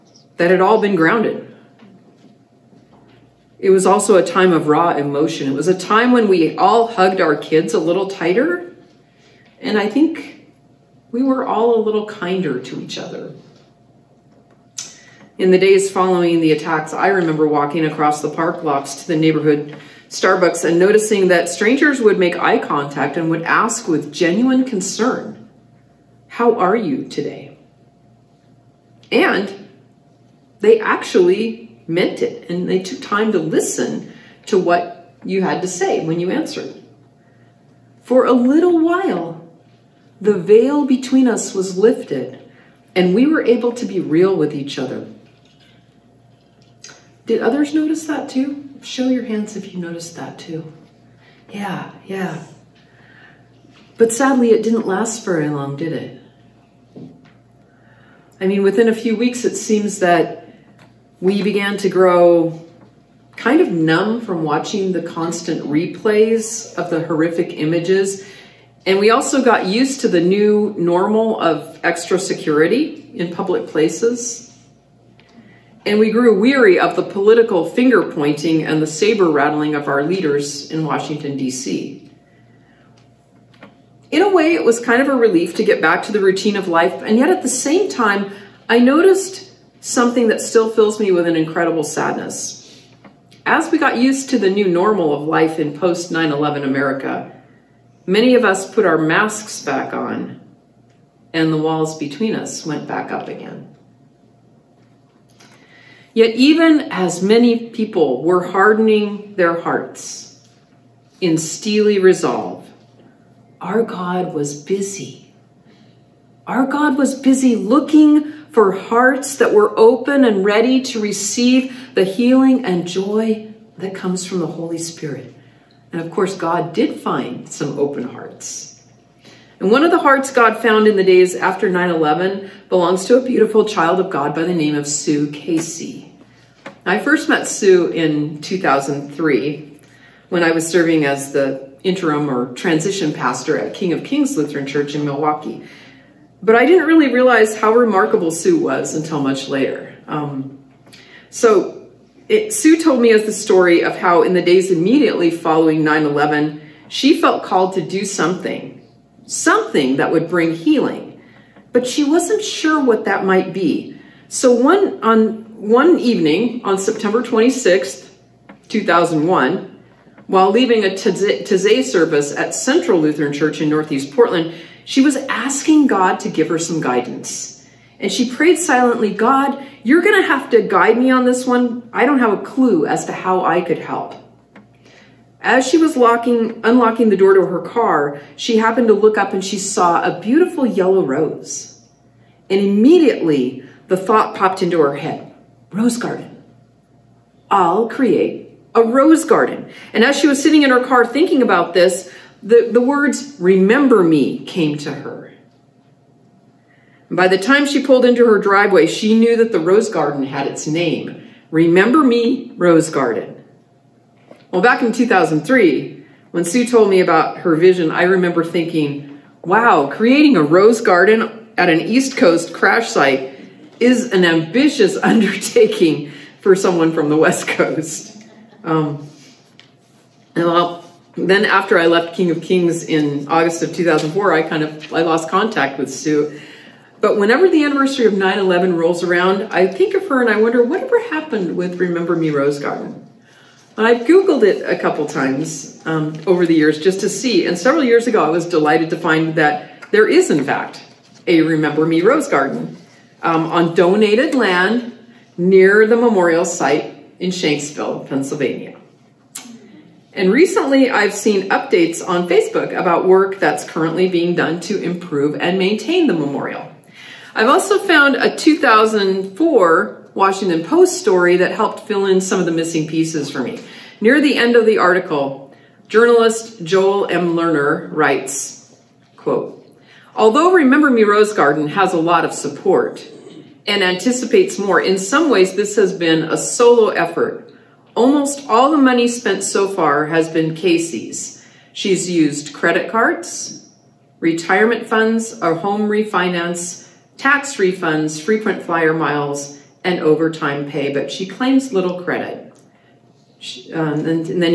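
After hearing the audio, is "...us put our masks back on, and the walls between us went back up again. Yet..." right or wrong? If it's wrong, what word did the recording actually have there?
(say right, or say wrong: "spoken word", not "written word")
right.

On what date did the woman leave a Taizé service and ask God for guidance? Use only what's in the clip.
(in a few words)
September 26th, 2001.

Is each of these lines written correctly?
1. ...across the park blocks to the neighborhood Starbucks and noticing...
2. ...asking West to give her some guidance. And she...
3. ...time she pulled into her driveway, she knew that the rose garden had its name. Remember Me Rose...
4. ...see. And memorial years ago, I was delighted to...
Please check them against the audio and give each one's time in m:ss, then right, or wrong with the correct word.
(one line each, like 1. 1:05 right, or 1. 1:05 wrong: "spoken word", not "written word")
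1. 0:17 right
2. 2:55 wrong: "God", not "West"
3. 3:27 right
4. 4:07 wrong: "several", not "memorial".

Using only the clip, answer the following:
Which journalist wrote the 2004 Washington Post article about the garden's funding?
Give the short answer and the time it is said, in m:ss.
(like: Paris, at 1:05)
Joel M. Lerner, at 4:36.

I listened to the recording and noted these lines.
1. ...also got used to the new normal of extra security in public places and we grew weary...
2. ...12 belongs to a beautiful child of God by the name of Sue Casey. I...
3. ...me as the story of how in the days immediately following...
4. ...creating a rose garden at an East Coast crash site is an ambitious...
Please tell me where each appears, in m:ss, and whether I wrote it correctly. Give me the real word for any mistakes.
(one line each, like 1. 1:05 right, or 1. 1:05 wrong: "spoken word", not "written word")
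1. 1:09 right
2. 2:11 wrong: "11", not "12"
3. 2:33 right
4. 3:39 right.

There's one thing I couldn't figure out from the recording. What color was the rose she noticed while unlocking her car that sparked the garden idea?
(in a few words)
Yellow.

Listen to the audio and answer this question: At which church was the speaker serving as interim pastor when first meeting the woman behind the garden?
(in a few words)
King of Kings Lutheran Church.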